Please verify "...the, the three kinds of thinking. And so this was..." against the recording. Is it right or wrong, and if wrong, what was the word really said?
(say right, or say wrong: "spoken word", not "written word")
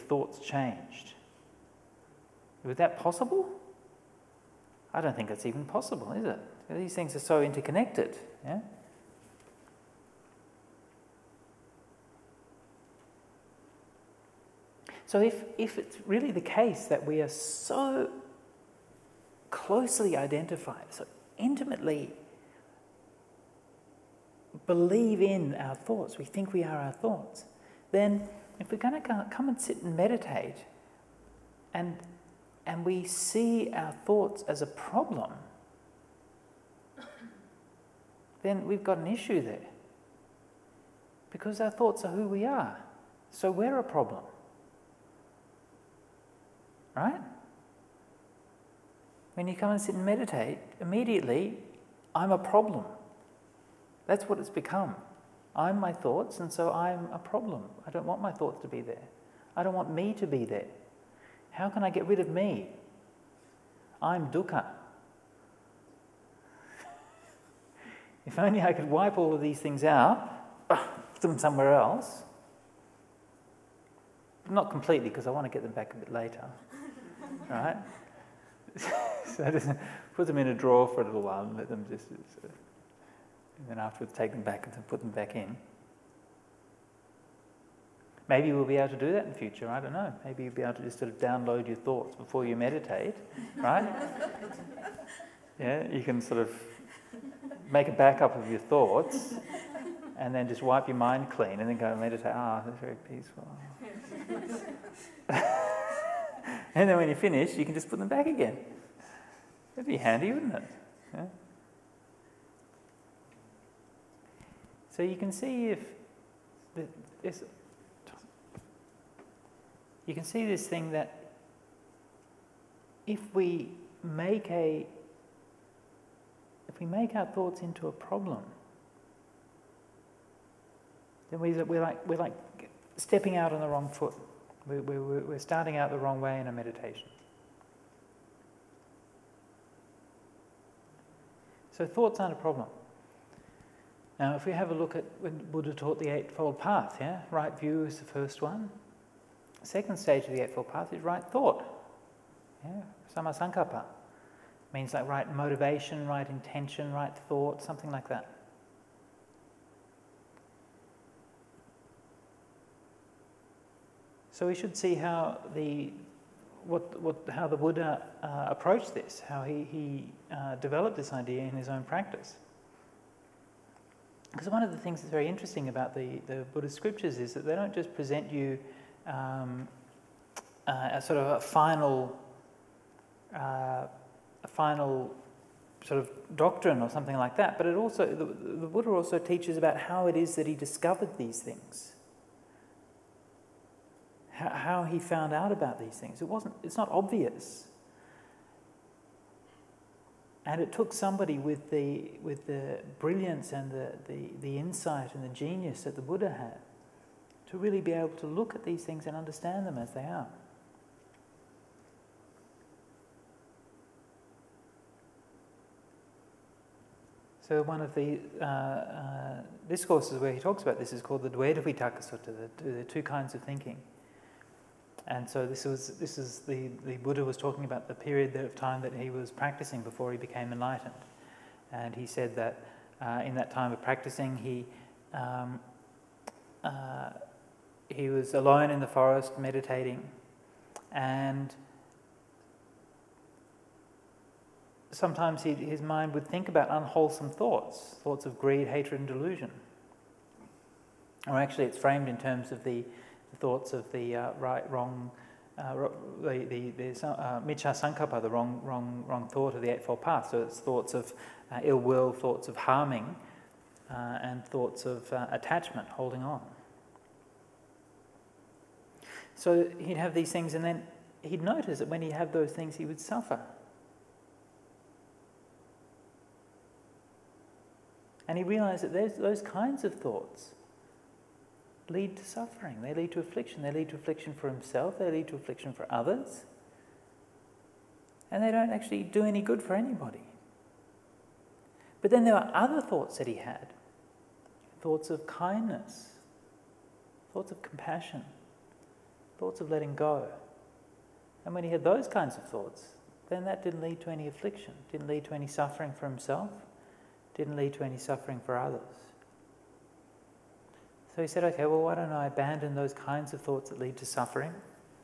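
wrong: "two", not "three".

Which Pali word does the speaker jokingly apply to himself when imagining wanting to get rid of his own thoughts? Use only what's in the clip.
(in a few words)
dukkha.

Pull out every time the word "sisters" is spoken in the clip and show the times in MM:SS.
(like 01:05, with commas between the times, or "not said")
not said.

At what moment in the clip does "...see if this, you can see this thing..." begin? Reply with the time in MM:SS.
01:55.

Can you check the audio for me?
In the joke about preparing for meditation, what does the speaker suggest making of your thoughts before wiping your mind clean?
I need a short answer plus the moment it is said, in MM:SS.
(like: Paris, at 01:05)
a backup, at 01:37.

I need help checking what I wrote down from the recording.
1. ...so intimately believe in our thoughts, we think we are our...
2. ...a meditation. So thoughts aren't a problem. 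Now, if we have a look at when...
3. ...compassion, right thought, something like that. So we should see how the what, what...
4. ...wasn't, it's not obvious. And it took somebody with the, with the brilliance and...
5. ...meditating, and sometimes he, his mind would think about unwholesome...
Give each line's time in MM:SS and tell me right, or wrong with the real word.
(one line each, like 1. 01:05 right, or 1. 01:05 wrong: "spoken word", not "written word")
1. 00:20 right
2. 02:16 right
3. 02:36 wrong: "intention", not "compassion"
4. 03:16 right
5. 03:59 right.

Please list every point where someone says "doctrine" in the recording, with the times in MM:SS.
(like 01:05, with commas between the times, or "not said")
03:06.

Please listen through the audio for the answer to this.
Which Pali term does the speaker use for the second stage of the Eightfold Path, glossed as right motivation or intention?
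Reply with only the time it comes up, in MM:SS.
02:33.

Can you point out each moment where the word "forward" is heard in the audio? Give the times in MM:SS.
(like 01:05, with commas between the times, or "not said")
not said.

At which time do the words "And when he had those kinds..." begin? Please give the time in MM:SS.
05:01.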